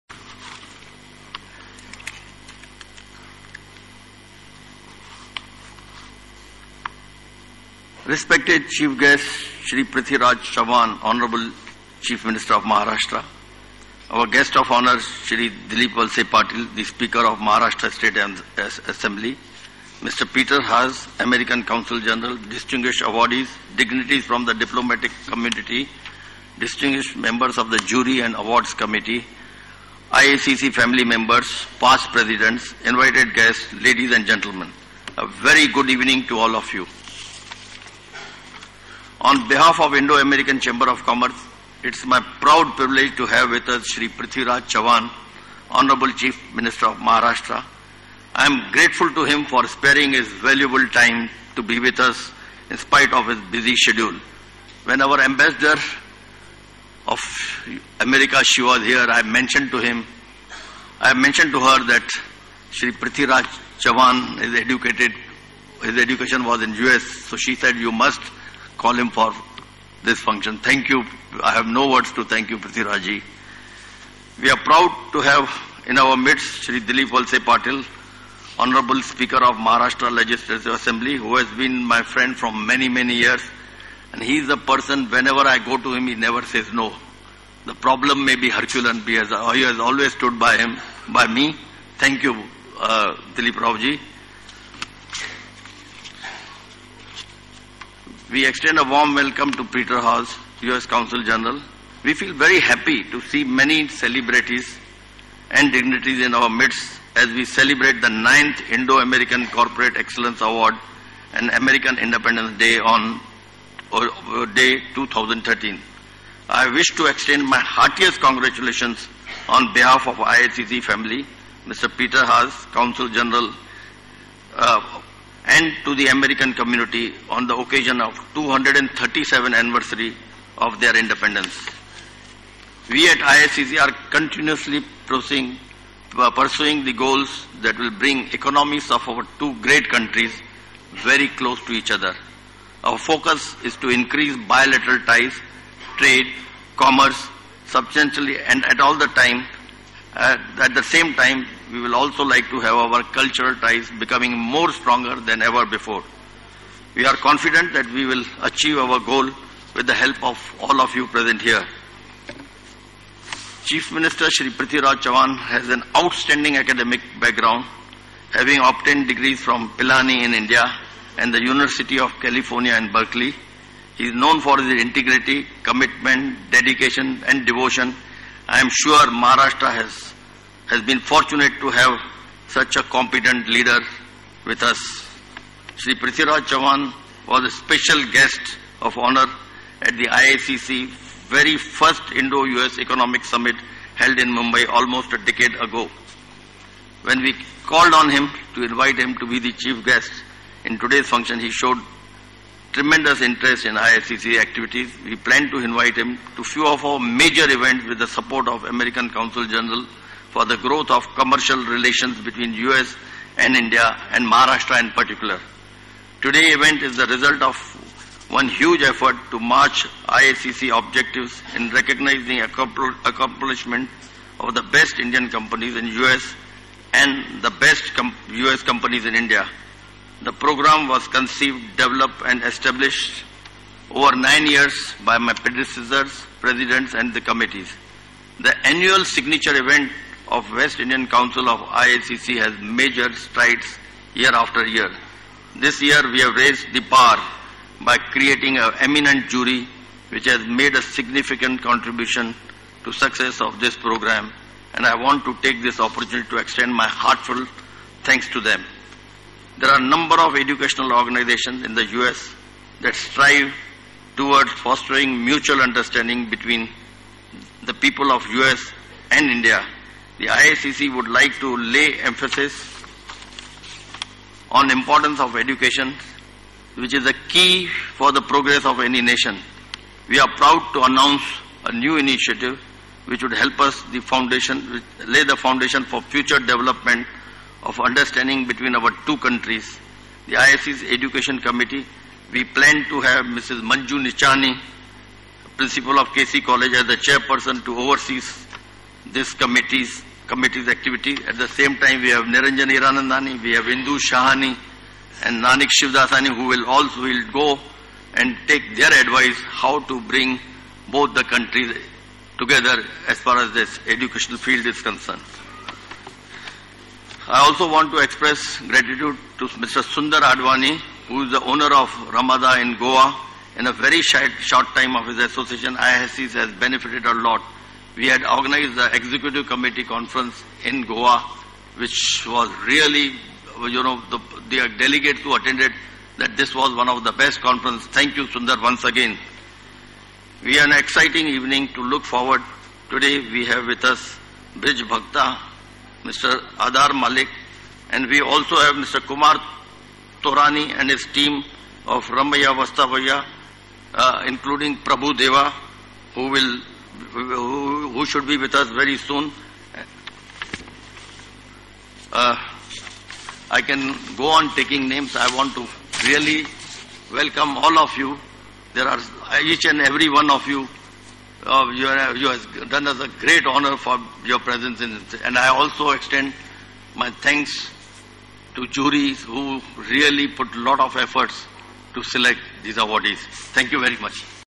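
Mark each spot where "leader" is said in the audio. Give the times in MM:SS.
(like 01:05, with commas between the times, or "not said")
03:03.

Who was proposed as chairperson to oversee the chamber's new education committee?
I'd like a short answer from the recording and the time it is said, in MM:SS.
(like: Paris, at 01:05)
Manju Nichani, at 04:53.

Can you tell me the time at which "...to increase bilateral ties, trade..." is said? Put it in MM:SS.
02:23.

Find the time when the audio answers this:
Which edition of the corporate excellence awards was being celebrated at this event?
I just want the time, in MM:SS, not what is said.
01:48.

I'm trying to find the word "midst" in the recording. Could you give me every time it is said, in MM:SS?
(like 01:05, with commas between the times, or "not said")
01:16, 01:46.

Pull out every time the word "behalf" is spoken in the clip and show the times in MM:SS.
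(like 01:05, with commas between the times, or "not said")
00:39, 01:59.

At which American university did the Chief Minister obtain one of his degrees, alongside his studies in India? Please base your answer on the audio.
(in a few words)
University of California in Berkeley.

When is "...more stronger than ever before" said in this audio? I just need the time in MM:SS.
02:34.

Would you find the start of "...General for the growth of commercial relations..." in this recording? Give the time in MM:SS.
03:29.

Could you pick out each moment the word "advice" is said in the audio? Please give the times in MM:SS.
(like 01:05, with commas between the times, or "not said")
05:09.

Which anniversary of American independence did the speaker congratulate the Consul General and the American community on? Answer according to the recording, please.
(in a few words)
237th.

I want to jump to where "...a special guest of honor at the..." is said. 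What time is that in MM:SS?
03:07.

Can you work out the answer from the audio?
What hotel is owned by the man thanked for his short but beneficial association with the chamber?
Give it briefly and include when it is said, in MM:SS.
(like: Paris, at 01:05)
Ramada, at 05:22.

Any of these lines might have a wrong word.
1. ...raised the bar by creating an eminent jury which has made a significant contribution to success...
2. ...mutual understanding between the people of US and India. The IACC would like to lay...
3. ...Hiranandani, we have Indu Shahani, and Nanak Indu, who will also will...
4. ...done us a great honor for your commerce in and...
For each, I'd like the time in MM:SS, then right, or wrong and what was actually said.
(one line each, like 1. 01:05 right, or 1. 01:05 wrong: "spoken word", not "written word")
1. 04:06 right
2. 04:25 right
3. 05:02 wrong: "Shivdasani", not "Indu"
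4. 06:12 wrong: "presence", not "commerce".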